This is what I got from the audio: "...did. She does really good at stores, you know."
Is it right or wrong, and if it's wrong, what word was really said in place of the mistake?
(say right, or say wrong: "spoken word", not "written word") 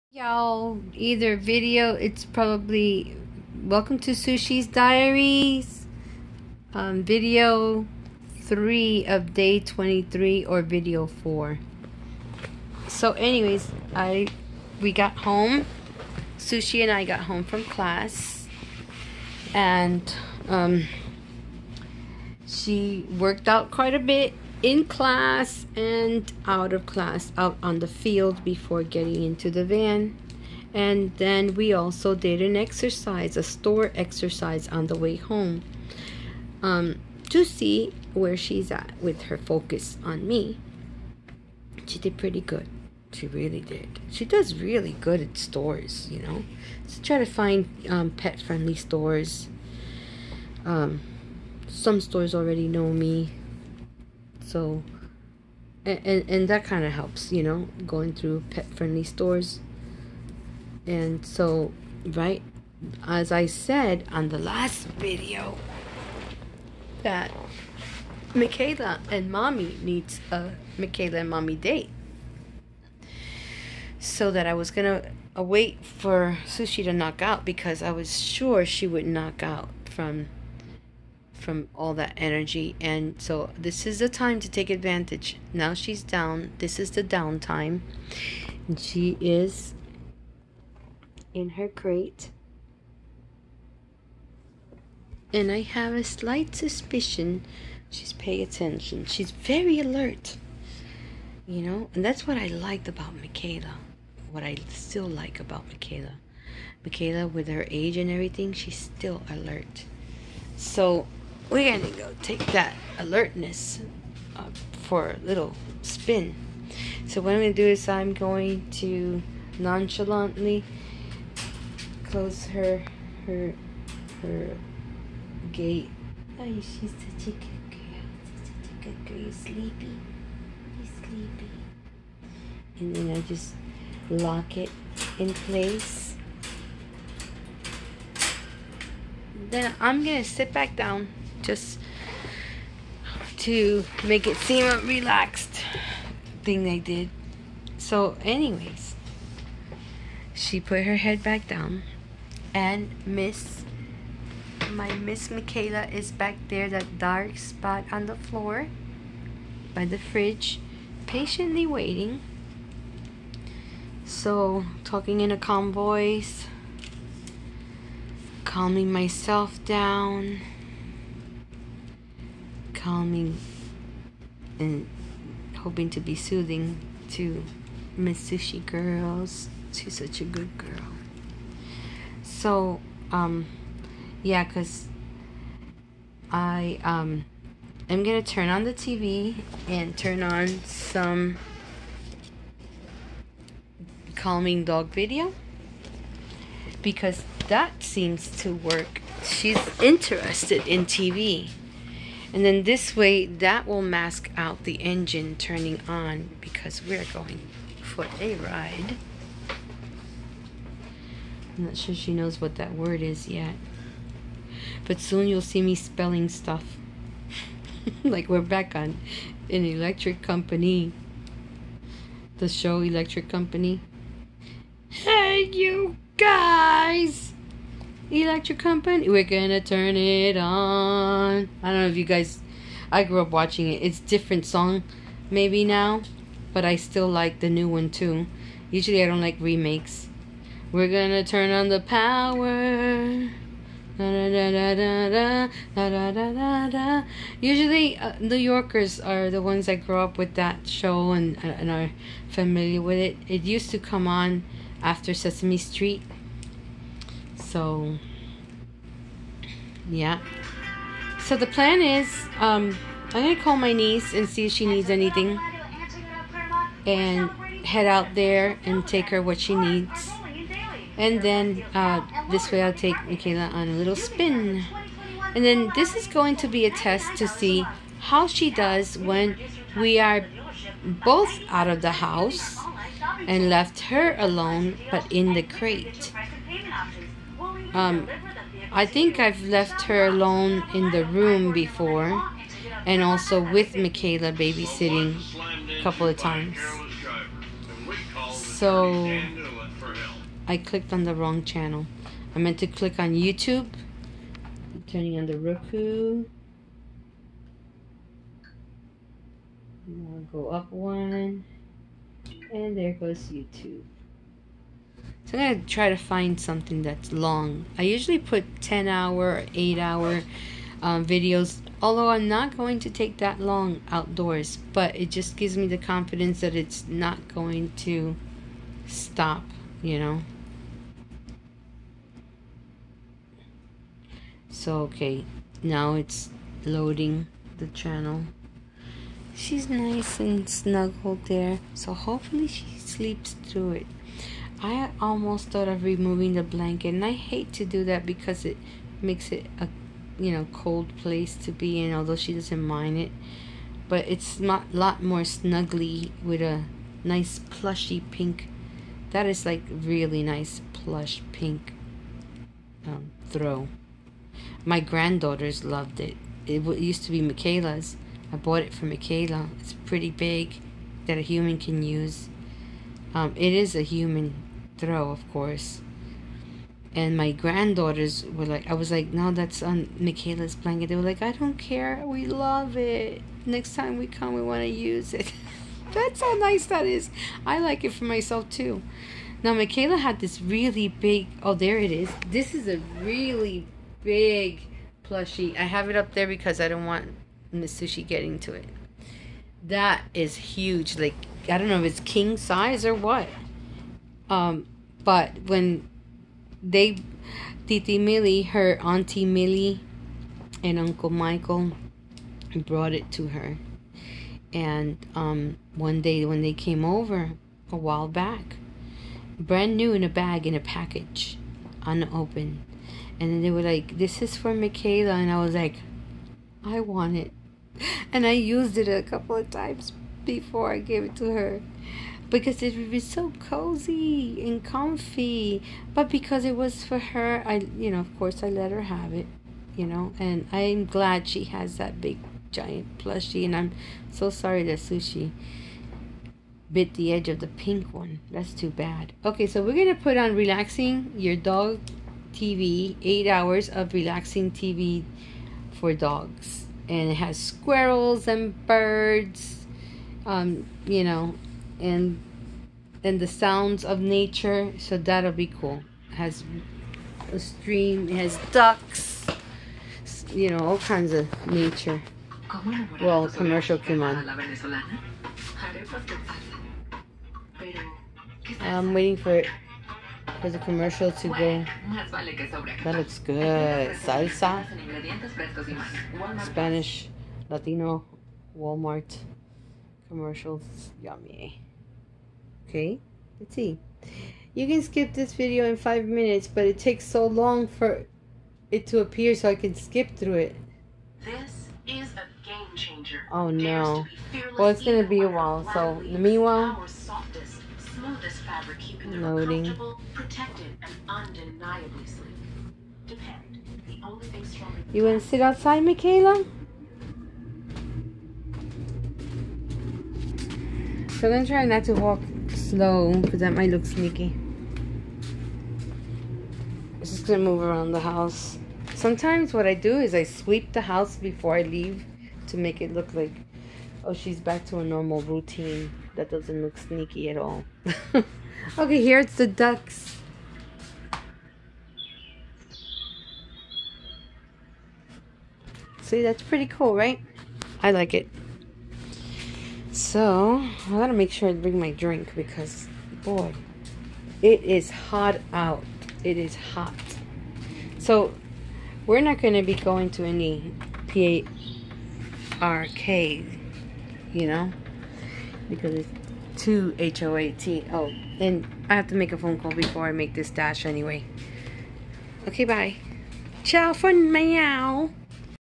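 right.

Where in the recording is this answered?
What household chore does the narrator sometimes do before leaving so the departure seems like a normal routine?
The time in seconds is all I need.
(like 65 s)
530 s.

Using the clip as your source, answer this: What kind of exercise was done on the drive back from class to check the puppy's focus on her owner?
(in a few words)
a store exercise.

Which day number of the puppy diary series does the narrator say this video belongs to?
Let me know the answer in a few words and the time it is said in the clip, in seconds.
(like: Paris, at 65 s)
23, at 9 s.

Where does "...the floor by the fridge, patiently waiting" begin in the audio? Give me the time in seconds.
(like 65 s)
158 s.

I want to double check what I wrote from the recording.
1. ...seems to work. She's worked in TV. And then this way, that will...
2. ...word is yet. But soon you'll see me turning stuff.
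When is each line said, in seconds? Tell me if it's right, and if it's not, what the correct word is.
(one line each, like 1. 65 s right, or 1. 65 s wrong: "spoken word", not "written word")
1. 197 s wrong: "interested", not "worked"
2. 212 s wrong: "spelling", not "turning".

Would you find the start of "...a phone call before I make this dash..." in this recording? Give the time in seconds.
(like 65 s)
569 s.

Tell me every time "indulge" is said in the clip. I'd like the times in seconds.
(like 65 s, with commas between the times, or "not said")
not said.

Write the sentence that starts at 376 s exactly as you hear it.
And my granddaughters were like, I was like, no, that's on Mikayla's blanket.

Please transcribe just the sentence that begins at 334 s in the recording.
So, okay, now it's loading the channel.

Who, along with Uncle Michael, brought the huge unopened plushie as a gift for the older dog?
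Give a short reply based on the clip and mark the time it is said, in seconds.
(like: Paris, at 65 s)
Auntie Millie, at 408 s.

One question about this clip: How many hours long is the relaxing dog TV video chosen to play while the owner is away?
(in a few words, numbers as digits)
8.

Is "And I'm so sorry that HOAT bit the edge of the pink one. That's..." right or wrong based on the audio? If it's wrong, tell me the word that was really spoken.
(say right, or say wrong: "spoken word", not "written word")
wrong: "Sushi", not "HOAT".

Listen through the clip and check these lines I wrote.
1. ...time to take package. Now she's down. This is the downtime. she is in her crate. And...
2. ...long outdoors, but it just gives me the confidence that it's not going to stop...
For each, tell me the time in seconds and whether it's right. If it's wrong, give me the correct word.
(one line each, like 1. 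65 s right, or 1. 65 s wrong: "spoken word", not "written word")
1. 84 s wrong: "advantage", not "package"
2. 323 s right.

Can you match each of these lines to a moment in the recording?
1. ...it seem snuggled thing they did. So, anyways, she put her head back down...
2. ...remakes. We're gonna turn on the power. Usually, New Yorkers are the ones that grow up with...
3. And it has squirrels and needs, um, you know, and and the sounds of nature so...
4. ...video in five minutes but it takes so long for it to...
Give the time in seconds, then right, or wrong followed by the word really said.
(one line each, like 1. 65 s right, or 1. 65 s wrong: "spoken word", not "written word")
1. 144 s wrong: "relaxed", not "snuggled"
2. 239 s right
3. 456 s wrong: "birds", not "needs"
4. 495 s right.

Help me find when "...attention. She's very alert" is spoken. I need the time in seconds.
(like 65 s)
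98 s.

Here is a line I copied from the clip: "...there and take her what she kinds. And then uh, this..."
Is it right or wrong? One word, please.
wrong.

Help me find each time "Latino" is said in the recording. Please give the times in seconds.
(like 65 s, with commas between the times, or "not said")
487 s.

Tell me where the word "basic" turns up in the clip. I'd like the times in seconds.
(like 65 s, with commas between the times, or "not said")
not said.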